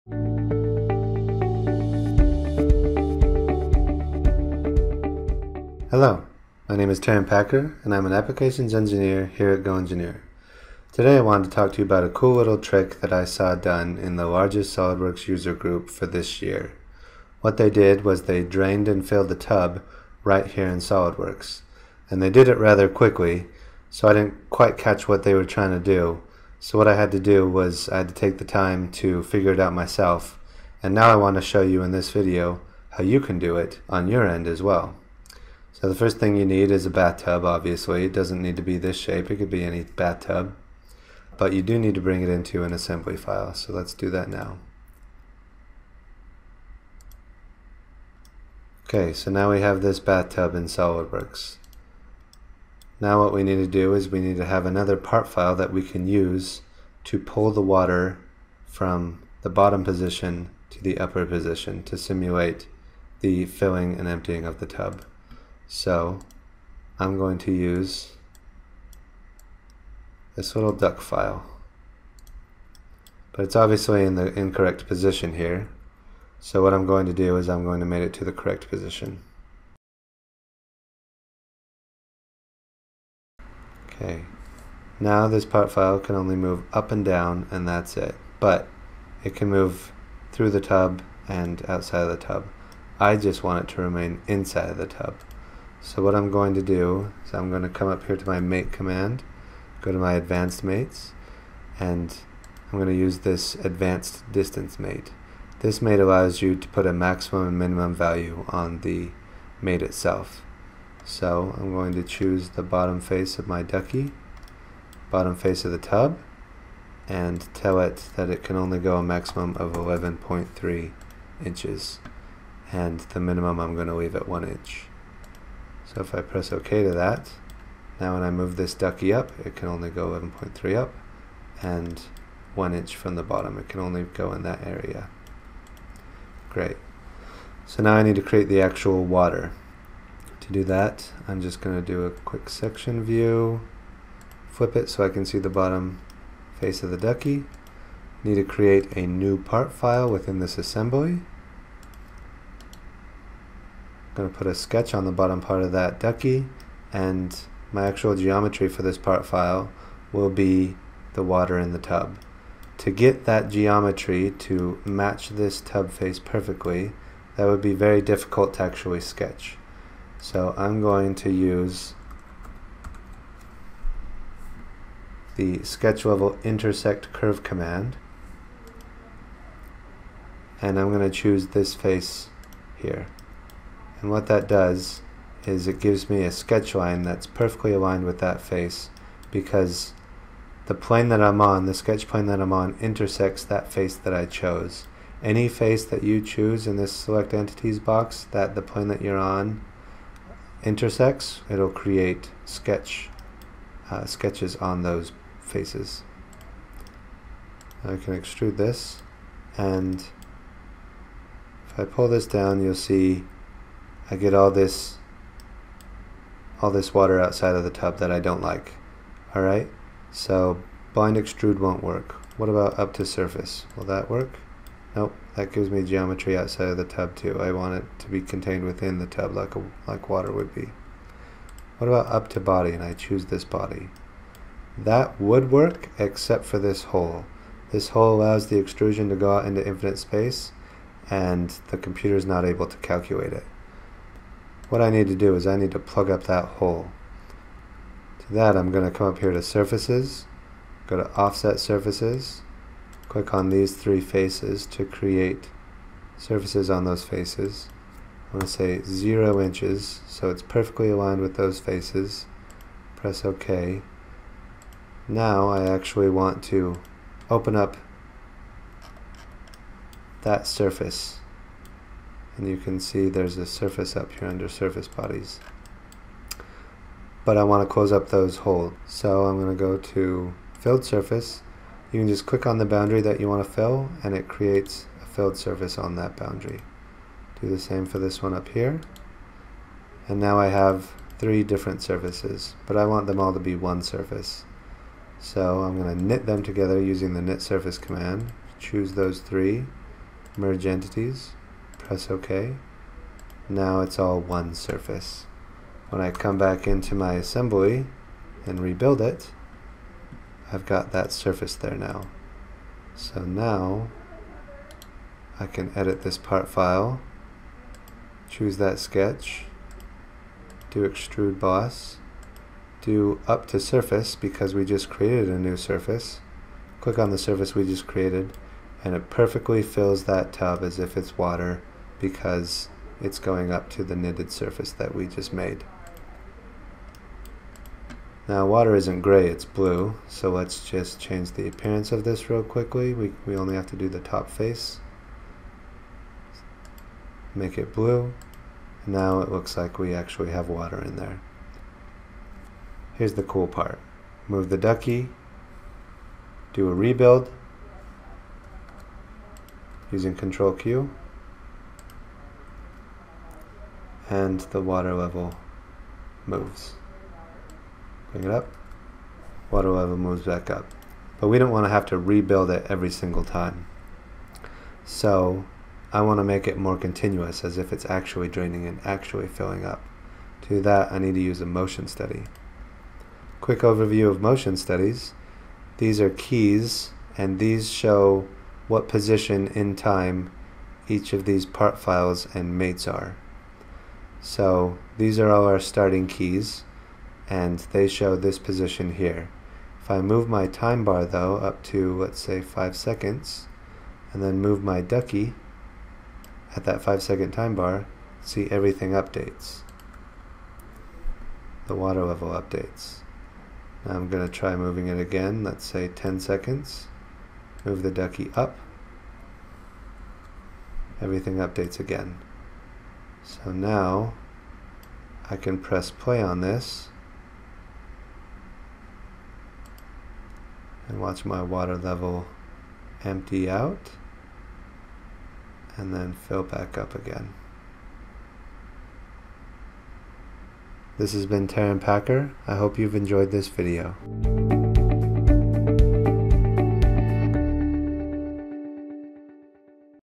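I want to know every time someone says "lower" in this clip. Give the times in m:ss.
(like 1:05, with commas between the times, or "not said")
not said.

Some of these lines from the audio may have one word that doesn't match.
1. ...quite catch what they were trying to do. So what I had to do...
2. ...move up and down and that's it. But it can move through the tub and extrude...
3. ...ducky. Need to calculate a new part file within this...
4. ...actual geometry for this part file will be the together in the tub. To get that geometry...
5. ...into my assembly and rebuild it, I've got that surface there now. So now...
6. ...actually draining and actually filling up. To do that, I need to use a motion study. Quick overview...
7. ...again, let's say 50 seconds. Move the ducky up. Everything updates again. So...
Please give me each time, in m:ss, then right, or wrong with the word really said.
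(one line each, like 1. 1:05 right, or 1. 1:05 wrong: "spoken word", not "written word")
1. 0:24 right
2. 1:26 wrong: "outside", not "extrude"
3. 2:26 wrong: "create", not "calculate"
4. 2:37 wrong: "water", not "together"
5. 5:06 right
6. 6:17 right
7. 6:54 wrong: "10", not "50".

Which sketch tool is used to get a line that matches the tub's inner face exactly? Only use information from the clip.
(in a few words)
intersect curve.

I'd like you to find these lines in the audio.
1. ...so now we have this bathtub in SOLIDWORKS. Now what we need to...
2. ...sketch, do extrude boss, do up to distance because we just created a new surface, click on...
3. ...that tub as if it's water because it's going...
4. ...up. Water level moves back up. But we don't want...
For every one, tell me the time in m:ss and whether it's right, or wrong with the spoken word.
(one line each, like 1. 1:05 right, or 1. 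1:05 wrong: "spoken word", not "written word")
1. 0:49 right
2. 5:18 wrong: "surface", not "distance"
3. 5:30 right
4. 6:08 right.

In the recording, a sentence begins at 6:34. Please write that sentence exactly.
So these are all our starting keys, and they show this position here.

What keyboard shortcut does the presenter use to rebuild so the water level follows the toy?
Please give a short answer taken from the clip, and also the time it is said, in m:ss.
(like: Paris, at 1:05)
Control Q, at 6:00.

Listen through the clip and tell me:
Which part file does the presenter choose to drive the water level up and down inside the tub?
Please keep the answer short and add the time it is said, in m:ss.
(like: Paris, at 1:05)
duck file, at 1:10.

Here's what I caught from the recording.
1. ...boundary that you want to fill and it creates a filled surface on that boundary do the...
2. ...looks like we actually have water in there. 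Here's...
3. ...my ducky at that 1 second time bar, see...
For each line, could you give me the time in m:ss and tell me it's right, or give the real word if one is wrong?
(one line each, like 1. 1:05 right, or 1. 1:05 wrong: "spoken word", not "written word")
1. 4:42 right
2. 5:49 right
3. 6:44 wrong: "5", not "1".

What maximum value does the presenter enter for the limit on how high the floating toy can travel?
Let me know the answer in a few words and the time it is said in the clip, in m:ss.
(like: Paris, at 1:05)
11.3 inches, at 1:59.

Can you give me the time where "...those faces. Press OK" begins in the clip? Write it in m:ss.
4:21.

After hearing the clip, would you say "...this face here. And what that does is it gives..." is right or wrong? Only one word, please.
right.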